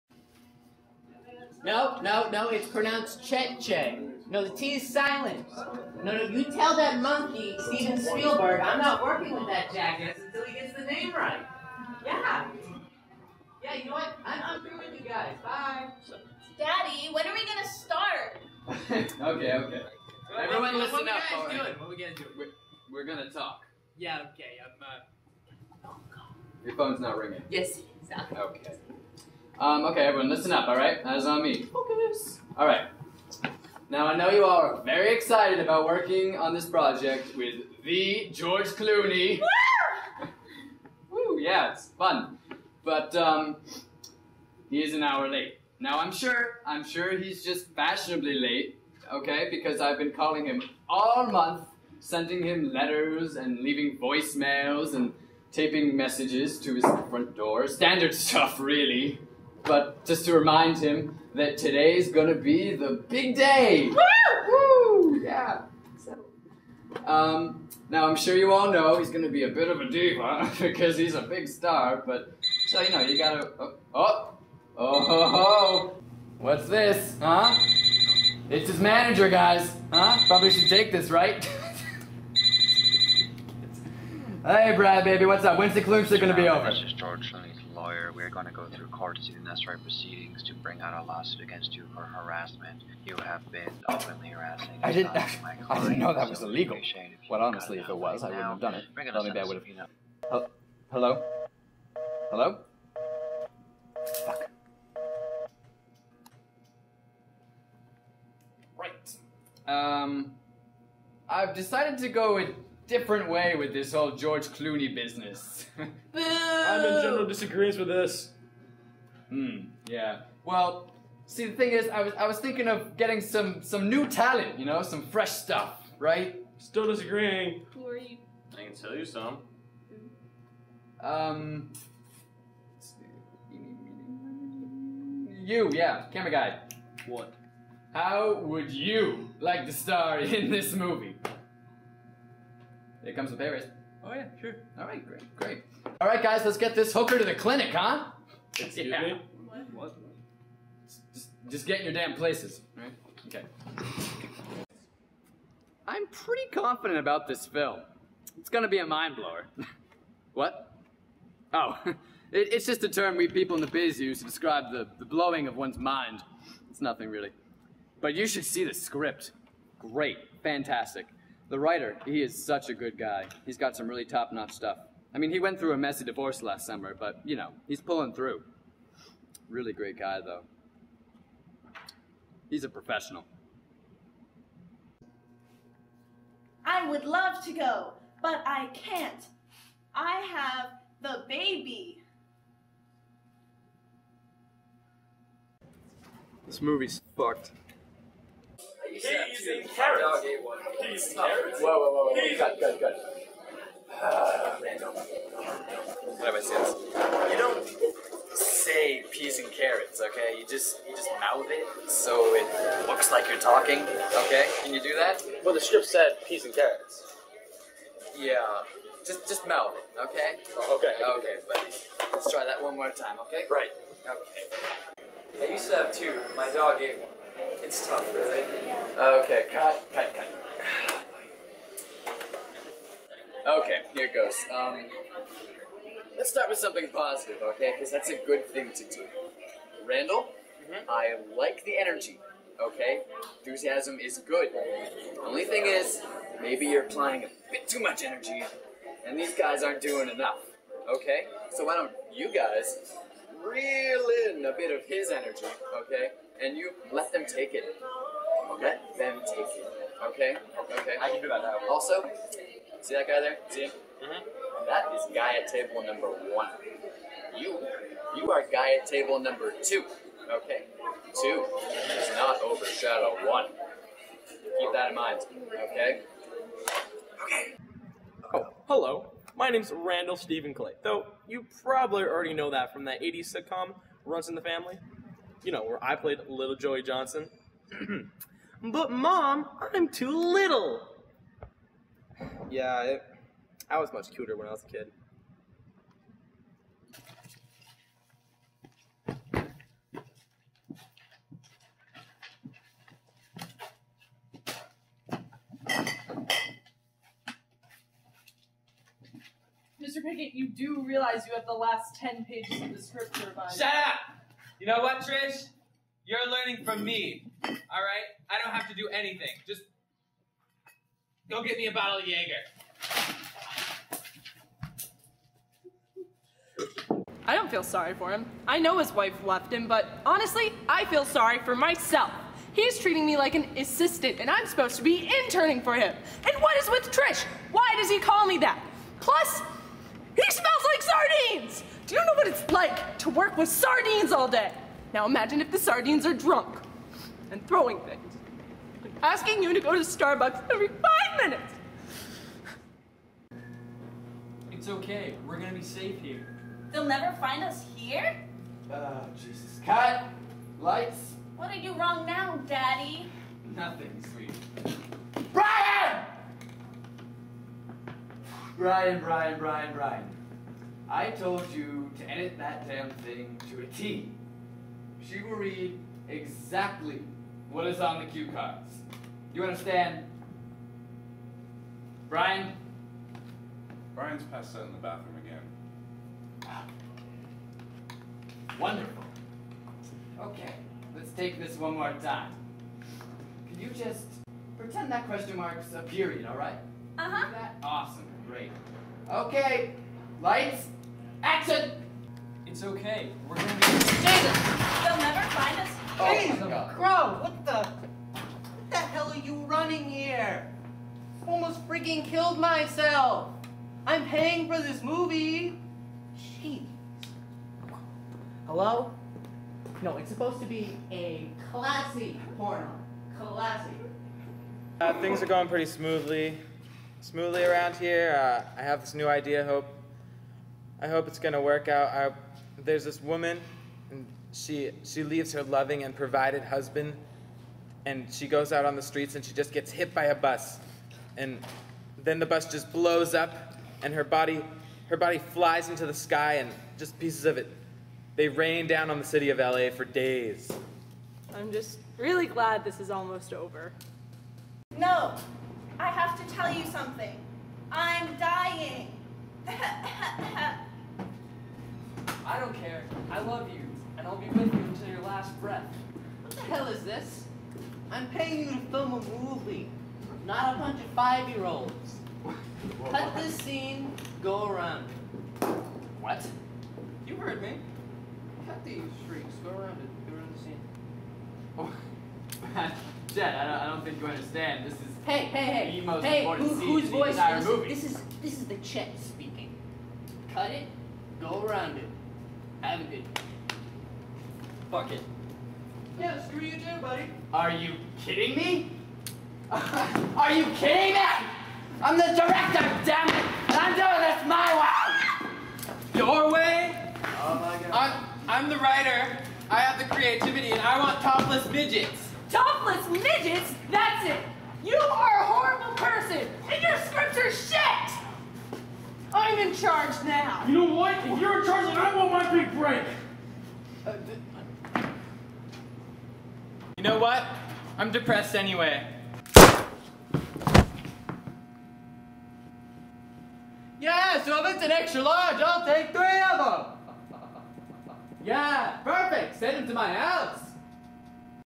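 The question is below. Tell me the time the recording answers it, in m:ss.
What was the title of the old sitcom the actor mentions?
4:44.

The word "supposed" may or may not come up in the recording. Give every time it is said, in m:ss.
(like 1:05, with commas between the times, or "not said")
5:34, 7:00.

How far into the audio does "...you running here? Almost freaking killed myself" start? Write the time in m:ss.
6:49.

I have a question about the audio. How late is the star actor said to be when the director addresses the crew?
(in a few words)
an hour.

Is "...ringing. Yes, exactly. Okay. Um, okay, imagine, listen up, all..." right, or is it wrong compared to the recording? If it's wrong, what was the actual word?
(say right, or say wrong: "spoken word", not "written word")
wrong: "everyone", not "imagine".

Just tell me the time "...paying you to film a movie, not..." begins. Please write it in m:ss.
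7:48.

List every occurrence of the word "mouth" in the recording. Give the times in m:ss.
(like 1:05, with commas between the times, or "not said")
3:31, 3:39.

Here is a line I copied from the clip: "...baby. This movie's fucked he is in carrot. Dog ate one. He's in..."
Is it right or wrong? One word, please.
right.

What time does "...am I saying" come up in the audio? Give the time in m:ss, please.
3:26.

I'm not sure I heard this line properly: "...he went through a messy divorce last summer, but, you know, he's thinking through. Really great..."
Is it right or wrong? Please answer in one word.
wrong.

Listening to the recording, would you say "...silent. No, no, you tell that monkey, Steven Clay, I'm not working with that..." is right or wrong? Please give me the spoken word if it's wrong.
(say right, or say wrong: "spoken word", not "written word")
wrong: "Spielberg", not "Clay".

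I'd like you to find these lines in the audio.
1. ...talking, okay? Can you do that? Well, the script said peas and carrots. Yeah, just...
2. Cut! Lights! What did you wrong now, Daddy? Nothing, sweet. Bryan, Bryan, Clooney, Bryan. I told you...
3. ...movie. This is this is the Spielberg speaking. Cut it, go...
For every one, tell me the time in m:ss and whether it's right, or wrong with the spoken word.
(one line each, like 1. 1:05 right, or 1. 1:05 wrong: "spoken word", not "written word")
1. 3:33 right
2. 5:59 wrong: "Bryan", not "Clooney"
3. 8:07 wrong: "Chet", not "Spielberg".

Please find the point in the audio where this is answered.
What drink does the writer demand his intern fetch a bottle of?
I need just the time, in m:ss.
5:22.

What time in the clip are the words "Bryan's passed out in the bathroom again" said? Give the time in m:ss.
6:23.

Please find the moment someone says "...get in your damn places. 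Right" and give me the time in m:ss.
2:31.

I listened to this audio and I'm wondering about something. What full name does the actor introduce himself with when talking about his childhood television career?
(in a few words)
Randall Stephen Clay.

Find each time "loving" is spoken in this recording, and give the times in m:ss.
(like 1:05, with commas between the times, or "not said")
7:15.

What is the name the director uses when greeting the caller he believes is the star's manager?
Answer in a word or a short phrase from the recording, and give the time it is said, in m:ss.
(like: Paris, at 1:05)
Brad, at 1:24.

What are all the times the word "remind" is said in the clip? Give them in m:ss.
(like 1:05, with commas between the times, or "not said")
1:00.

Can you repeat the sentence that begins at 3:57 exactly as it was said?
Because that's a good thing to do.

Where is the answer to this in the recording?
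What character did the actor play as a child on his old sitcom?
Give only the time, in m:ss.
4:46.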